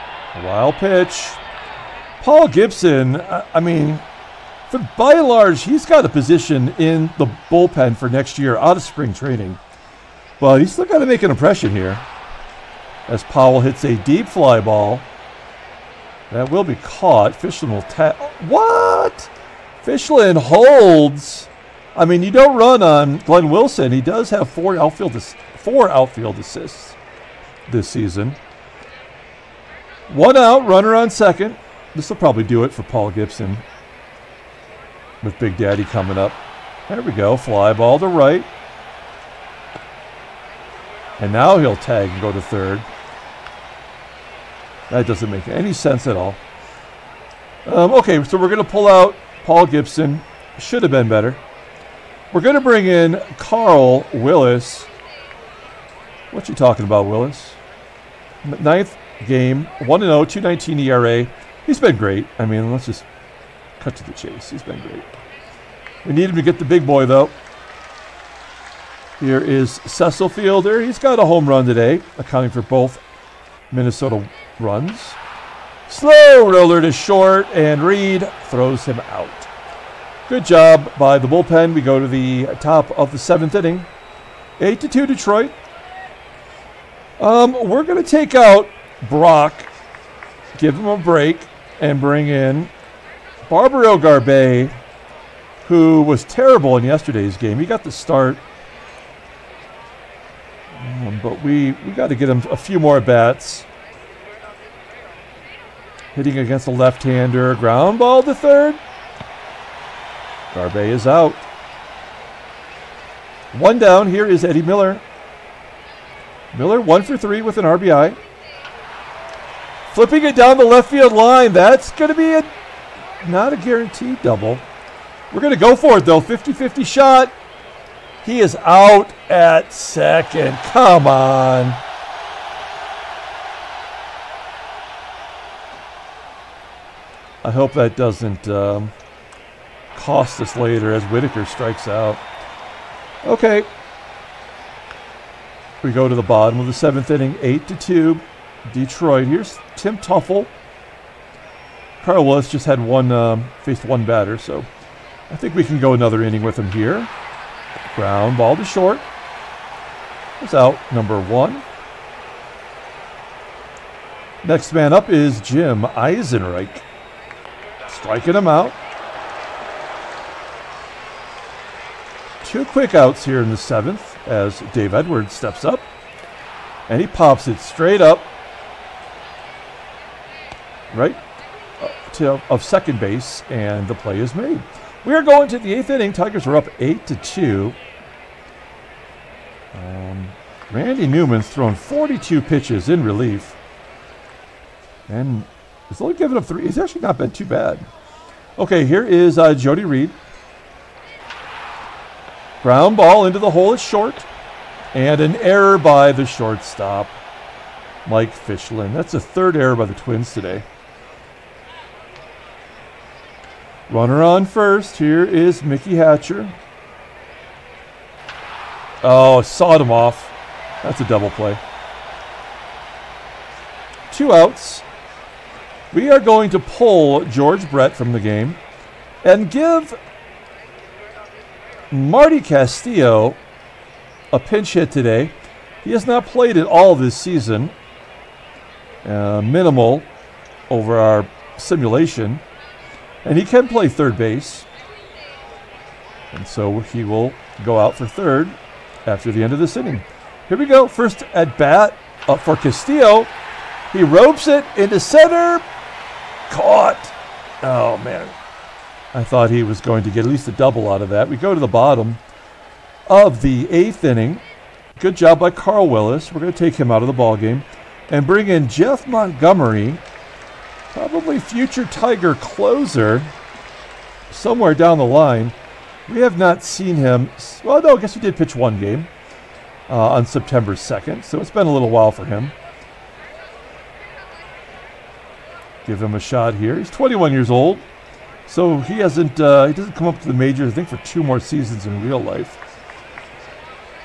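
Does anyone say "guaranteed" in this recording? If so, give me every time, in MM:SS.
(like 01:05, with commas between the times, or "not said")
02:03.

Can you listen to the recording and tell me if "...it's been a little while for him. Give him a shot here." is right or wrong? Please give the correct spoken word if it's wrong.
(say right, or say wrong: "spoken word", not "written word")
right.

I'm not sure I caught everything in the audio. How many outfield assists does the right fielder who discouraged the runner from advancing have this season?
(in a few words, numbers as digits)
4.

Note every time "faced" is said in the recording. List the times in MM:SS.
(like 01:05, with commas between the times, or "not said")
02:33.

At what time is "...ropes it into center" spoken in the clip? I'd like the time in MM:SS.
04:14.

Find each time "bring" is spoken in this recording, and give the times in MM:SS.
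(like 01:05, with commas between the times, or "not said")
00:52, 01:31, 04:28.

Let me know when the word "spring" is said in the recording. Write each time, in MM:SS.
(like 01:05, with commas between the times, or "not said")
00:08.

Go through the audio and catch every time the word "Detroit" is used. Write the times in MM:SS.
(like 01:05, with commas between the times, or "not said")
01:25, 02:28.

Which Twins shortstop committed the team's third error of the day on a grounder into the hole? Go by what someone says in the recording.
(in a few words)
Mike Fischlin.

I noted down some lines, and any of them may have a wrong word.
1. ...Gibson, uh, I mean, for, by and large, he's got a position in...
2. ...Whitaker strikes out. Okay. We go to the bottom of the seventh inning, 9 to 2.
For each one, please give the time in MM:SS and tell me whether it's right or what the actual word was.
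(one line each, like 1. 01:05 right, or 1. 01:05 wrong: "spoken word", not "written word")
1. 00:02 right
2. 02:21 wrong: "8", not "9".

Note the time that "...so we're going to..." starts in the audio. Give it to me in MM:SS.
00:48.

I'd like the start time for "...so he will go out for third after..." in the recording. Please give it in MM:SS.
04:06.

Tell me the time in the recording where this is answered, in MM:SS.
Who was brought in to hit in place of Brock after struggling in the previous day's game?
01:33.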